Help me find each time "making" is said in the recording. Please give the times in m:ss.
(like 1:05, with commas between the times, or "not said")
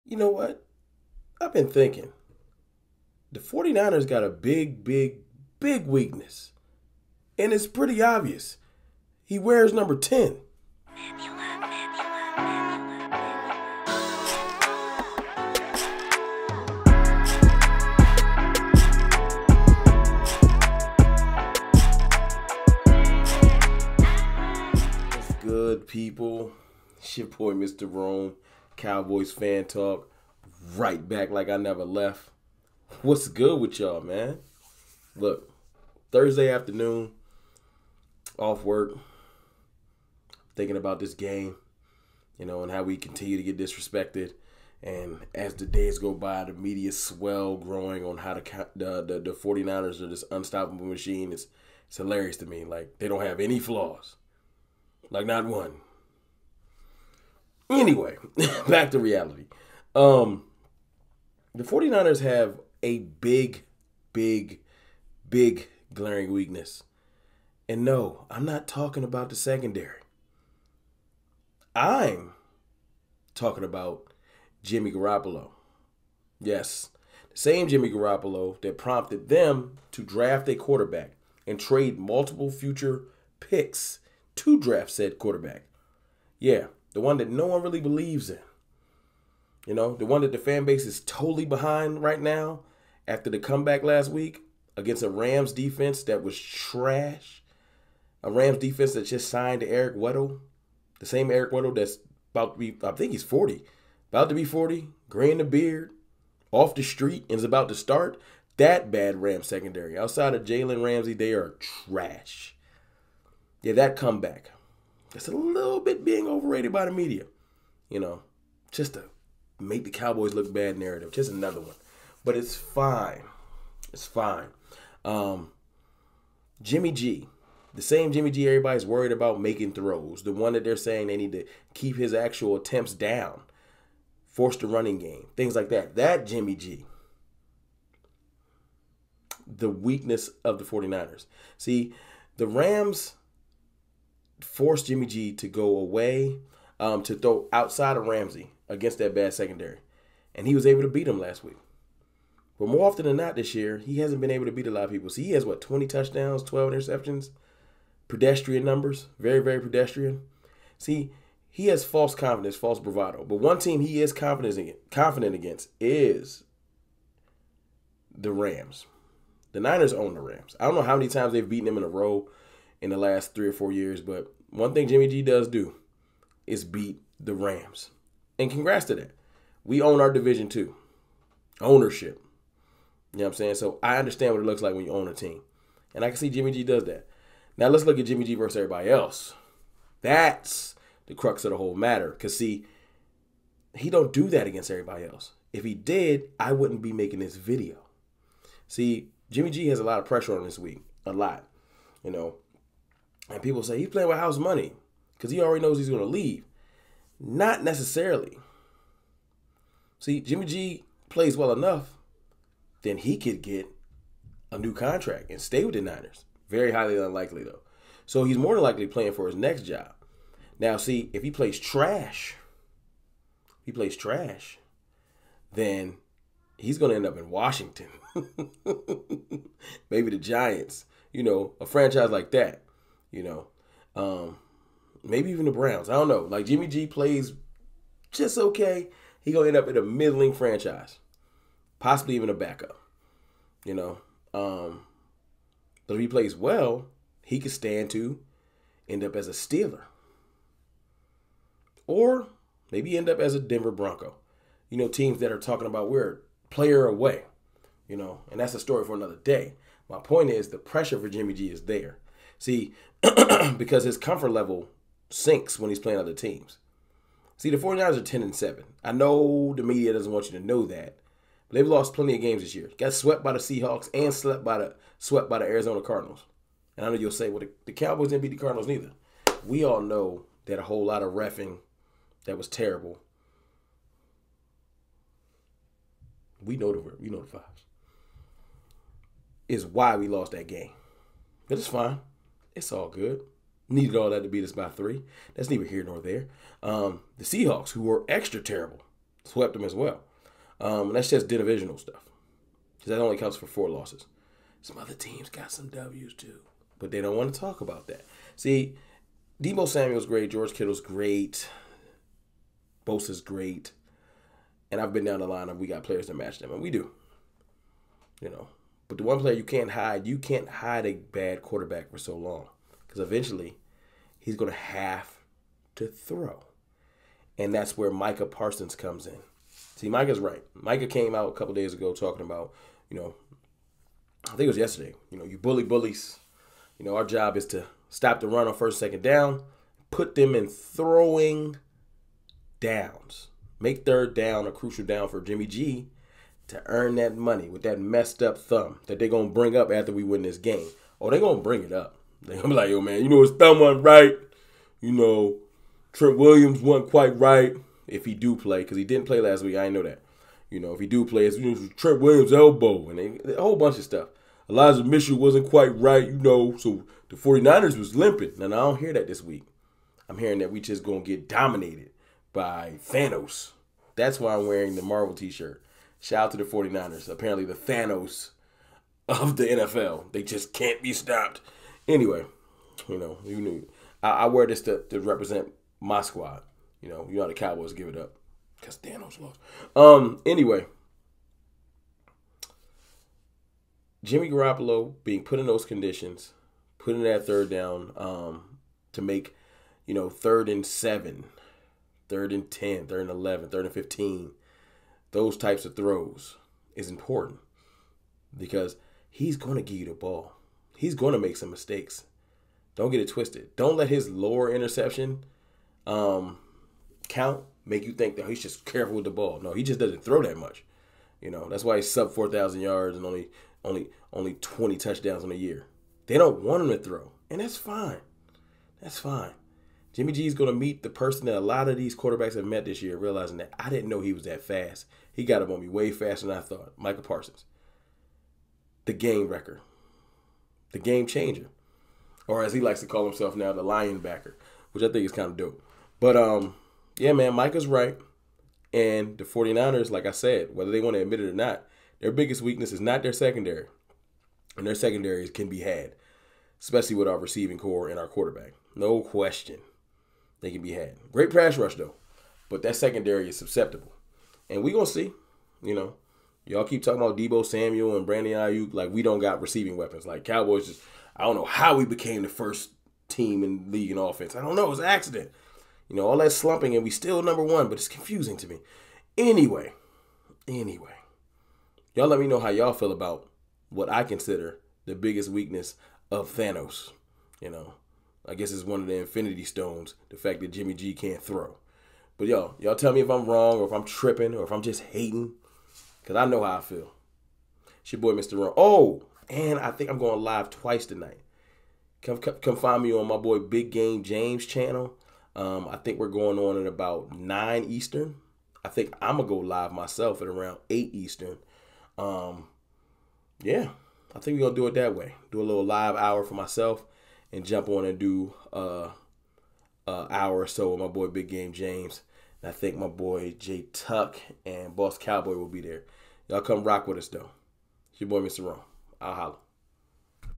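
2:09, 3:16.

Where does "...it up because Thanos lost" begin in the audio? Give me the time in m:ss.
6:27.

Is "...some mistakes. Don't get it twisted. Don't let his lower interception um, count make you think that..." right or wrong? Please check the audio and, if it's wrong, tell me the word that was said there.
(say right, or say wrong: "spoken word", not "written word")
right.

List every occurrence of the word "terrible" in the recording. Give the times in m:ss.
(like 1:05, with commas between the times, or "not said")
4:42, 4:58.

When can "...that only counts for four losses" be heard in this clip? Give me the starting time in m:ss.
5:02.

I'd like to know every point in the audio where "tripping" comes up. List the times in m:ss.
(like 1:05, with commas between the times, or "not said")
8:13.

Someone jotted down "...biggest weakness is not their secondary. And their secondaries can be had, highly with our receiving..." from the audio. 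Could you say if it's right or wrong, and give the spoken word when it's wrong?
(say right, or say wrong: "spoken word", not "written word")
wrong: "especially", not "highly".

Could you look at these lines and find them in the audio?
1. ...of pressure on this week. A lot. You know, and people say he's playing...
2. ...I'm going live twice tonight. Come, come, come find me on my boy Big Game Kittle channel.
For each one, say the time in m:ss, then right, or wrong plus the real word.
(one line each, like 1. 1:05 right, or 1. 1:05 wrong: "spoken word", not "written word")
1. 3:19 right
2. 8:19 wrong: "James", not "Kittle".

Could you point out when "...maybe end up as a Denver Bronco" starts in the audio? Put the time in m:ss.
4:12.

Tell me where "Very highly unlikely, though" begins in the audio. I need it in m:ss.
3:36.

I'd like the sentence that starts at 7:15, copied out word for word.
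He got up on me way faster than I thought.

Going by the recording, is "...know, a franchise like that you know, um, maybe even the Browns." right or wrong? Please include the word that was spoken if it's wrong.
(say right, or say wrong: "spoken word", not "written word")
right.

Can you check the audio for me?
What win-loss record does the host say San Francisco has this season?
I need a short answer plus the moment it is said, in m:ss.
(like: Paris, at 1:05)
10 and 7, at 4:28.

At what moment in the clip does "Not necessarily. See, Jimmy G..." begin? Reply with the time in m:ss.
3:27.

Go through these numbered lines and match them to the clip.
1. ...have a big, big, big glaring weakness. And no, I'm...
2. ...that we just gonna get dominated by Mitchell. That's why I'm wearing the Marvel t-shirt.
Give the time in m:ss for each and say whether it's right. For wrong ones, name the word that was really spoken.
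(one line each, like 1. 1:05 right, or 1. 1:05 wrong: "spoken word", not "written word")
1. 1:02 right
2. 6:10 wrong: "Thanos", not "Mitchell".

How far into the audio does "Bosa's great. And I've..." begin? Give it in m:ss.
5:12.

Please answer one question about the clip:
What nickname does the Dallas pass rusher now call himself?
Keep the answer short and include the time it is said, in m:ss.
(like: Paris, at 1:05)
the lion backer, at 7:23.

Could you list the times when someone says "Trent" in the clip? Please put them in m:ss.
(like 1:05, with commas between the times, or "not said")
5:55, 6:01.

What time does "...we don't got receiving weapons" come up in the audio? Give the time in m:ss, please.
7:48.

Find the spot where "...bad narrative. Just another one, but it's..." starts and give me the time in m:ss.
2:00.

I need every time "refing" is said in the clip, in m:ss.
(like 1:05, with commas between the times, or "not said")
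4:41.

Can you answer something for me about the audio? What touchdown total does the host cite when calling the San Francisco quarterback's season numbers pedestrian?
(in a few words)
20.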